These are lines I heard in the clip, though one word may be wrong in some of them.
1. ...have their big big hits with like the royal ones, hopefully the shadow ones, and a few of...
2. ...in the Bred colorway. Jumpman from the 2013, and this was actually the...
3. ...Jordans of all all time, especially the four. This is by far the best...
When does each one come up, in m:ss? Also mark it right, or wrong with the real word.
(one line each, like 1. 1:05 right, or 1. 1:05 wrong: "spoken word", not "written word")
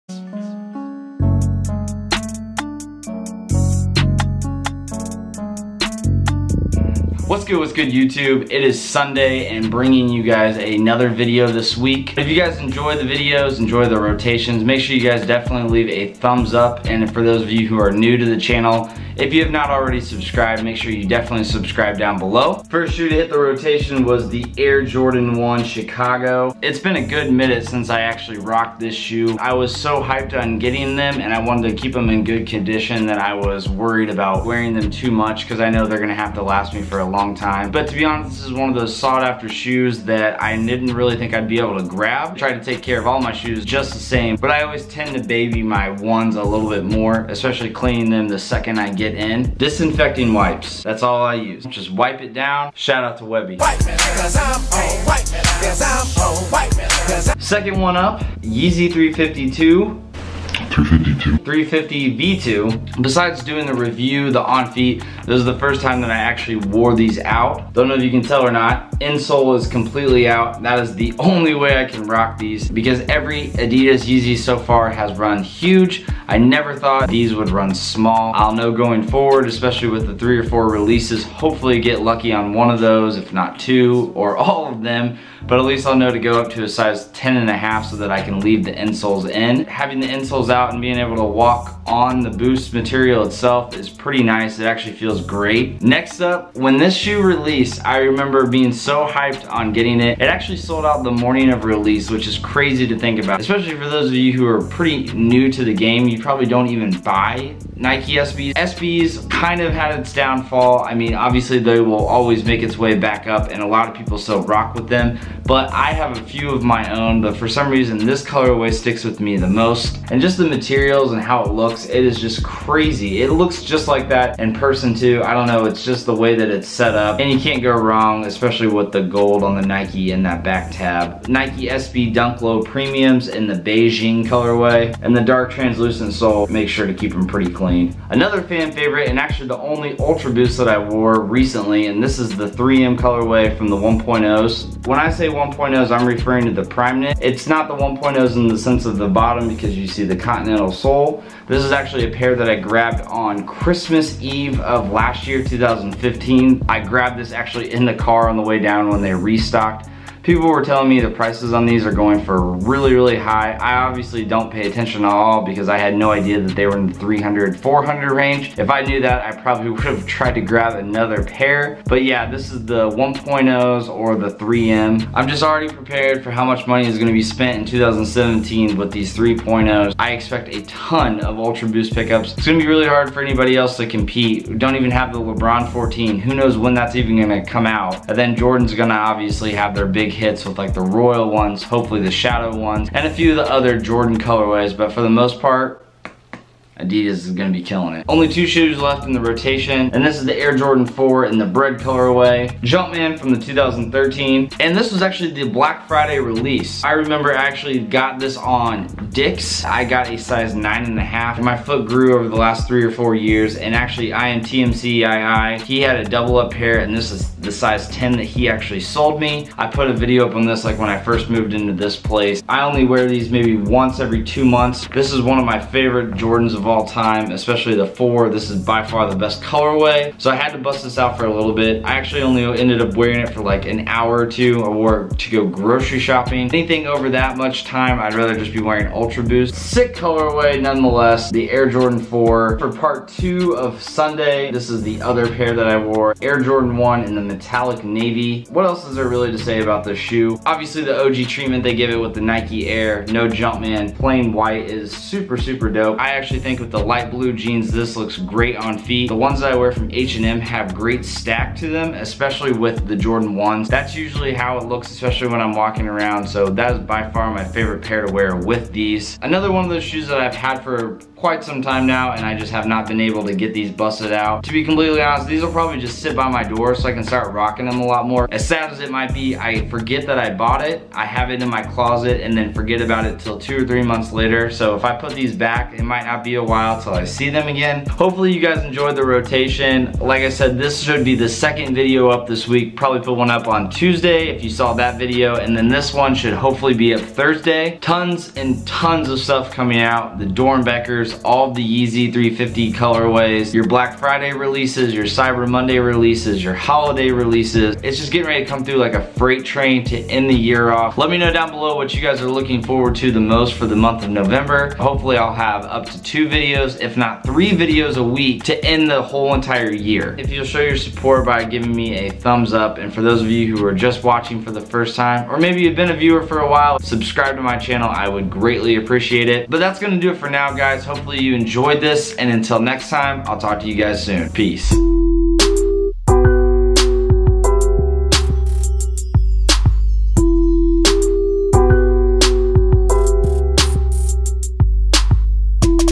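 1. 3:09 right
2. 3:21 right
3. 3:46 right.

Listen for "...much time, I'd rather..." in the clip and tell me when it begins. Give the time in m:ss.
3:57.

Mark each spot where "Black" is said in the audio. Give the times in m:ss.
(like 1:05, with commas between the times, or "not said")
3:25, 5:03.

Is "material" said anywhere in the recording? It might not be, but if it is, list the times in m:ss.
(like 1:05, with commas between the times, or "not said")
1:32, 2:00.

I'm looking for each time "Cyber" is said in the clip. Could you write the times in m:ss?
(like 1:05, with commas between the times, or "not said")
5:05.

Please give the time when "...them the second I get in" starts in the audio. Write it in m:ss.
0:48.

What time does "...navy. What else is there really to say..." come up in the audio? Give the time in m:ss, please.
4:07.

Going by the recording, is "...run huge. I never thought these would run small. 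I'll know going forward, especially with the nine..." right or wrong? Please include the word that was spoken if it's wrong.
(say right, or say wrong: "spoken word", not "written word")
wrong: "three", not "nine".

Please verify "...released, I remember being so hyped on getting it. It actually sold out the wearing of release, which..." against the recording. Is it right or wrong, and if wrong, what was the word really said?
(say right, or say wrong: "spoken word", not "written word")
wrong: "morning", not "wearing".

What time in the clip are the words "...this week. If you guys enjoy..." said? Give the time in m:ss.
0:11.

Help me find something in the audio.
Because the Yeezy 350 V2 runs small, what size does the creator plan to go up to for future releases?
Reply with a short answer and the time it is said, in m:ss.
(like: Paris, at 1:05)
10 and a half, at 1:27.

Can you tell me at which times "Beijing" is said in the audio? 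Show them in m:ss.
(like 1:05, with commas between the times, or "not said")
2:13.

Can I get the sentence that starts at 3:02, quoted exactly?
It's gonna be really hard for anybody else to compete.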